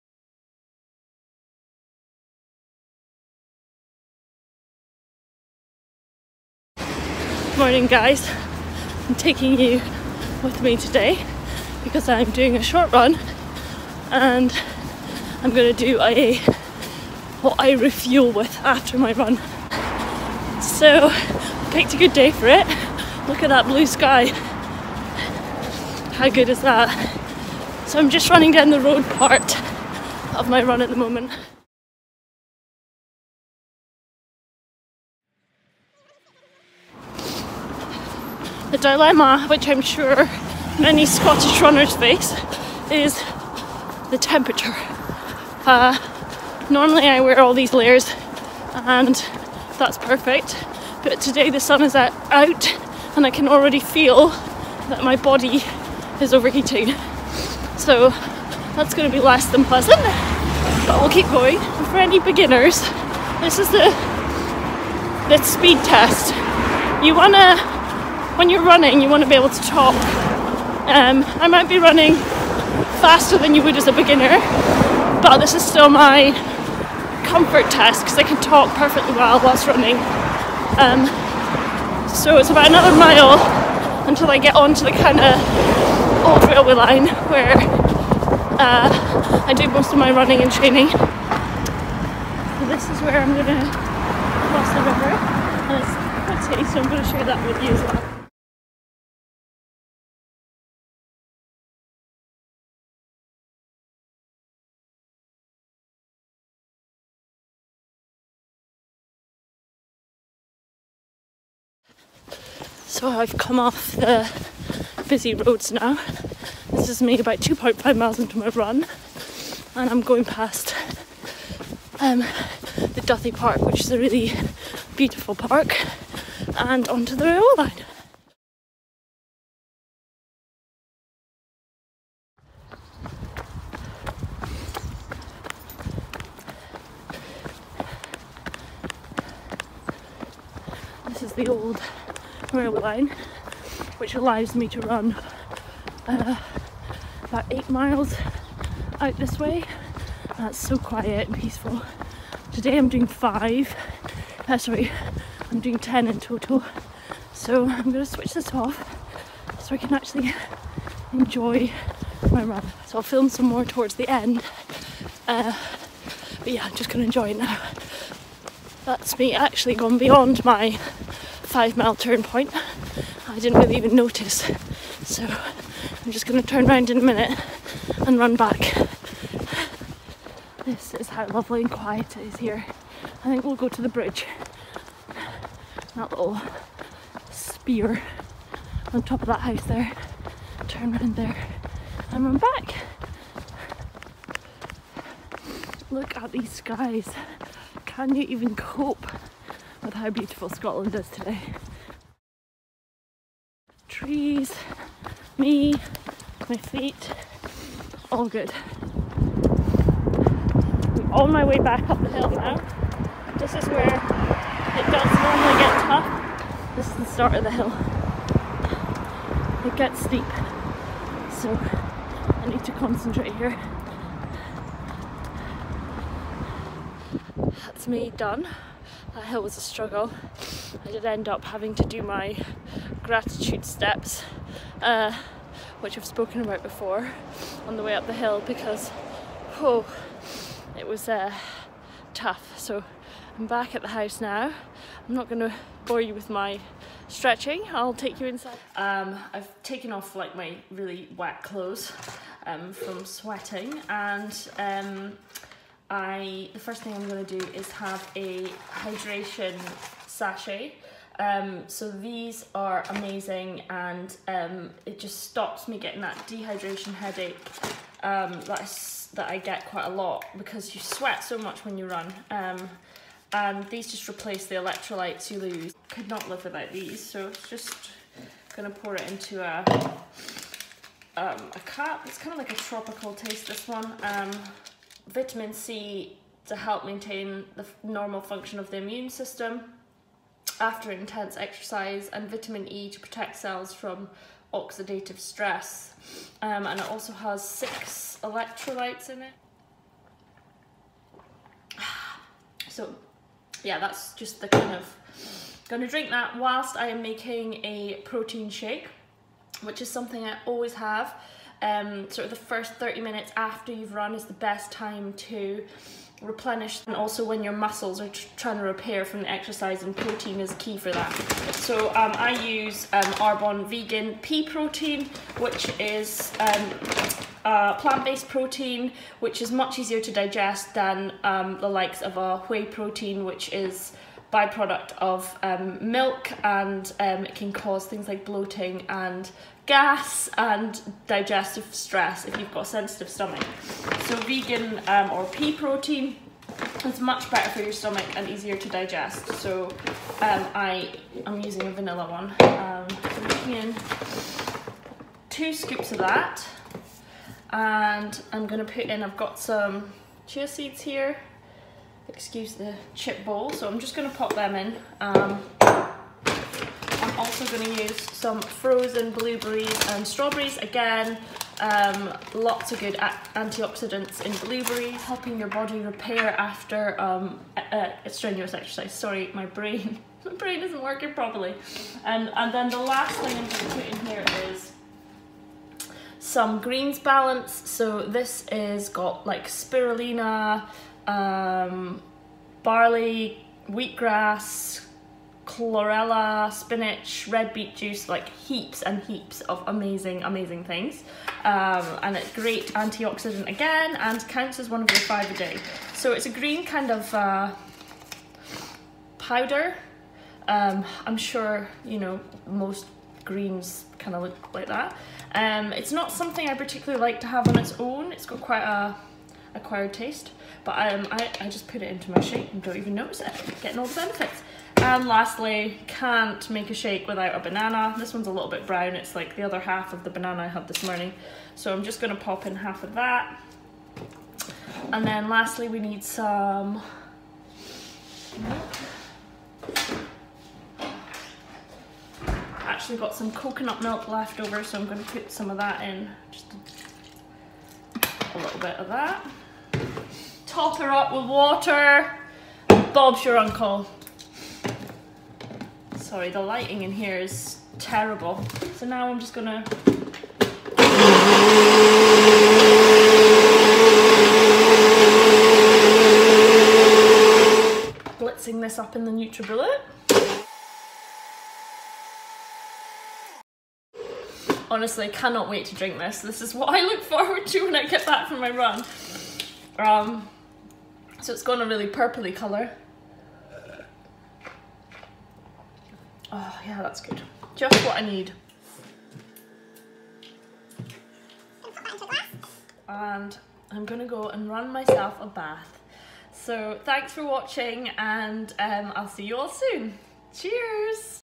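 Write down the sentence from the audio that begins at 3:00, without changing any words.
This is how lovely and quiet it is here.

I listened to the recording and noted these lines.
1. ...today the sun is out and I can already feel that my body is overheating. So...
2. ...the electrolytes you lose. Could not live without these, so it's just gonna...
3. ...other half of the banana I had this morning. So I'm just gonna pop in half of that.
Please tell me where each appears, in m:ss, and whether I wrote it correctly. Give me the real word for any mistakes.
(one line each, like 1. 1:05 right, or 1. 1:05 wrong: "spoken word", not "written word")
1. 0:51 right
2. 4:34 right
3. 7:09 right.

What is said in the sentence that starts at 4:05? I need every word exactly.
I'm not going to bore you with my stretching.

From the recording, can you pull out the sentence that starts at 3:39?
It gets steep, so I need to concentrate here.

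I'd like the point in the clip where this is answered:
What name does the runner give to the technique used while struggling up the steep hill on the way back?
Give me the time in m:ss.
3:53.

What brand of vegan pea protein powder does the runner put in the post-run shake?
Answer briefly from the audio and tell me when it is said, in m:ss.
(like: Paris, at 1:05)
Arbonne, at 5:23.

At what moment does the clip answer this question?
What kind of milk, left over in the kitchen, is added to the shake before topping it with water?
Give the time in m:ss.
7:23.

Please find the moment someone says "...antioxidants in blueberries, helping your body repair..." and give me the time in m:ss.
6:13.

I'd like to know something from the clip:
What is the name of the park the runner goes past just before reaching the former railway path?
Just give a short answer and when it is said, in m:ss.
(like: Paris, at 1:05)
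Duthie Park, at 2:03.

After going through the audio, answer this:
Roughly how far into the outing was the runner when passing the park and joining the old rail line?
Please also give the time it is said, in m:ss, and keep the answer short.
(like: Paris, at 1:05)
2.5 miles, at 1:57.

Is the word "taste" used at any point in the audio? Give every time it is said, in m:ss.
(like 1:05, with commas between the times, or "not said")
4:43, 6:59.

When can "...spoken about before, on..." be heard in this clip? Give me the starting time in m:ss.
3:56.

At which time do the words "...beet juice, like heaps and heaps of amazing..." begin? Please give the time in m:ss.
6:37.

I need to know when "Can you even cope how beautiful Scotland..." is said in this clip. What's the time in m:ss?
3:17.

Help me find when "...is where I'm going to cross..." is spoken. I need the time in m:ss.
1:32.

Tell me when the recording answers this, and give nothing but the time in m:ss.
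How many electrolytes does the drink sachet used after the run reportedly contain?
4:57.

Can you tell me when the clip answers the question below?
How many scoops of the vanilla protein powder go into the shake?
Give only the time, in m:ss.
5:55.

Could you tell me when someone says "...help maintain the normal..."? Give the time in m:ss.
4:46.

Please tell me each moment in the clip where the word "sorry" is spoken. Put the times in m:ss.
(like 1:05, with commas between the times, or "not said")
2:34, 6:18, 7:36.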